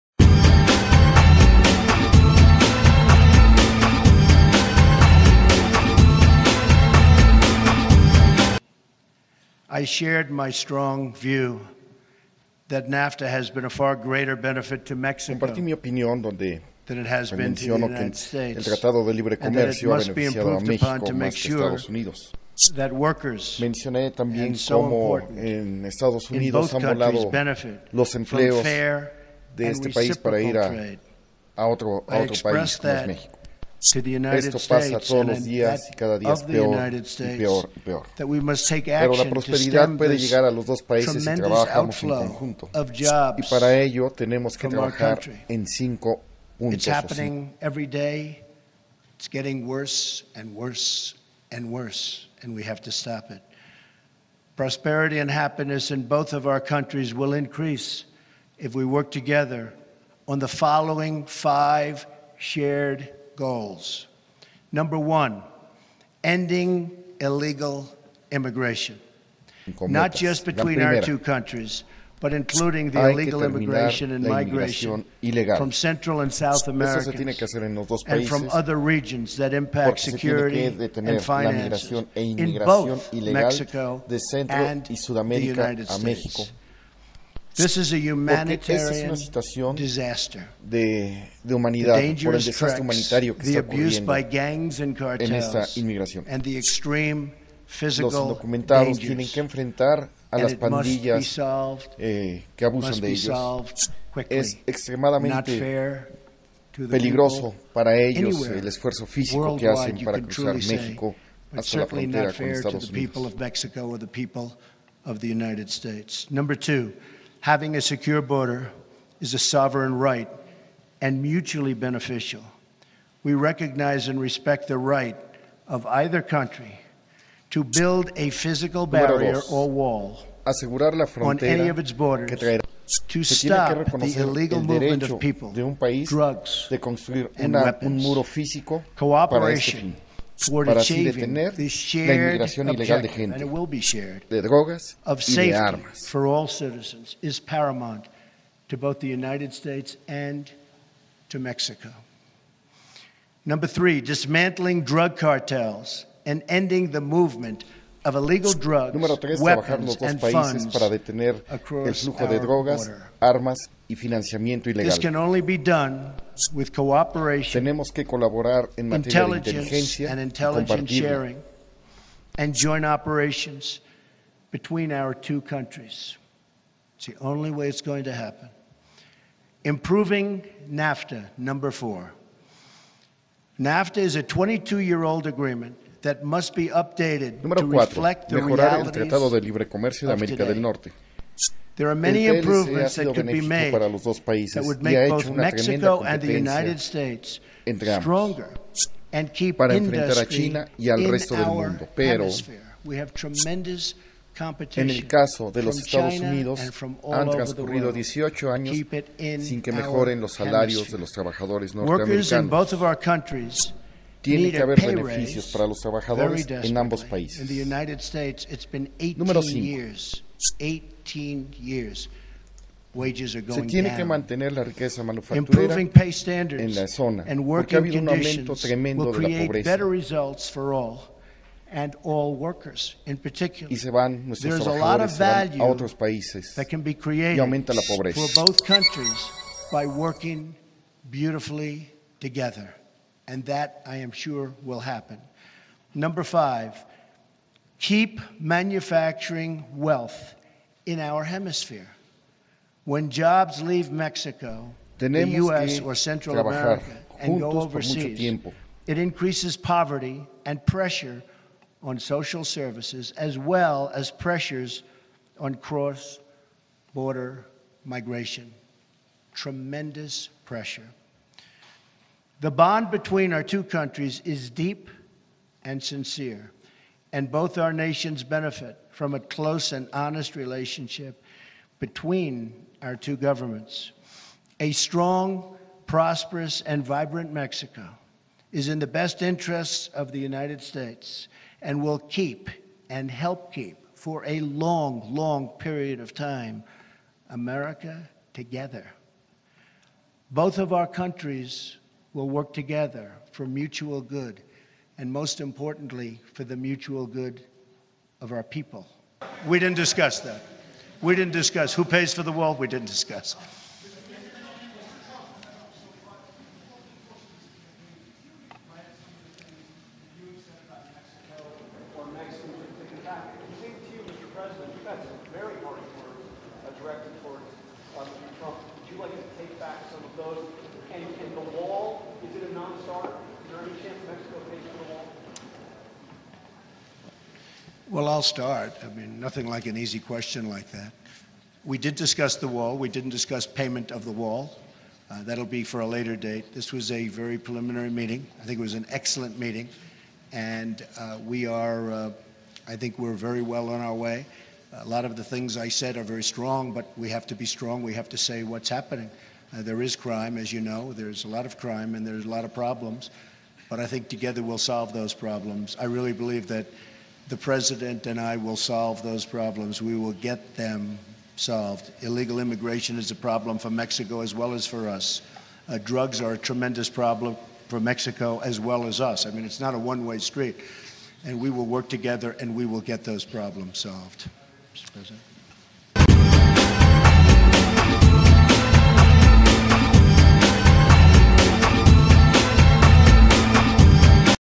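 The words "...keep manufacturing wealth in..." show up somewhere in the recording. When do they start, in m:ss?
4:07.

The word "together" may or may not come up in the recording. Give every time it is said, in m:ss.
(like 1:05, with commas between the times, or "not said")
0:59, 4:02, 4:58, 5:02, 6:04, 6:21.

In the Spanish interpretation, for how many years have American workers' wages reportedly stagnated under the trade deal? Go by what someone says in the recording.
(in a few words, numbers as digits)
18 years.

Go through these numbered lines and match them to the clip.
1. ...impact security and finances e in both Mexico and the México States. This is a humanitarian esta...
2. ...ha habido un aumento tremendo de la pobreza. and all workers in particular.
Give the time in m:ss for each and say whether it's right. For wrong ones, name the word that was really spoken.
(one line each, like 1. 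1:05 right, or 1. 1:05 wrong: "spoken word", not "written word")
1. 1:19 wrong: "United", not "México"
2. 3:47 right.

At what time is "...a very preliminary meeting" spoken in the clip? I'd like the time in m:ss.
5:46.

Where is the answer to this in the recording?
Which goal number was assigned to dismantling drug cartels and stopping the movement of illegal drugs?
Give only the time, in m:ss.
2:33.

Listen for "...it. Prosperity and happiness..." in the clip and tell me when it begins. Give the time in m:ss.
0:53.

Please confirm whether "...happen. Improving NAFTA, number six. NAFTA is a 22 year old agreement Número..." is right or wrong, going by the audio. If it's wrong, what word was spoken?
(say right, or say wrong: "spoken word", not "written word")
wrong: "four", not "six".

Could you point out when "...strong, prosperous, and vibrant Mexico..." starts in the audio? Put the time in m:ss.
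4:44.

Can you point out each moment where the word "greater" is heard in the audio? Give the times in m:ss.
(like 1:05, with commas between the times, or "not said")
0:13.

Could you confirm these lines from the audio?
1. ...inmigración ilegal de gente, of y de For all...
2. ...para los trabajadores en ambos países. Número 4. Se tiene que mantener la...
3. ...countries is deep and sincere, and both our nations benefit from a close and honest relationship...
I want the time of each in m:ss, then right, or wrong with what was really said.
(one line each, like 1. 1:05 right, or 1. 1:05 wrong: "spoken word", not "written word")
1. 2:22 right
2. 3:35 wrong: "5", not "4"
3. 4:33 right.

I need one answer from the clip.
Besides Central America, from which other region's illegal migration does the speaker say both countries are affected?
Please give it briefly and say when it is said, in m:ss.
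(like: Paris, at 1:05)
South America, at 1:16.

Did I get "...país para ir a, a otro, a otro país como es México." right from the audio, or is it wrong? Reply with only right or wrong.
right.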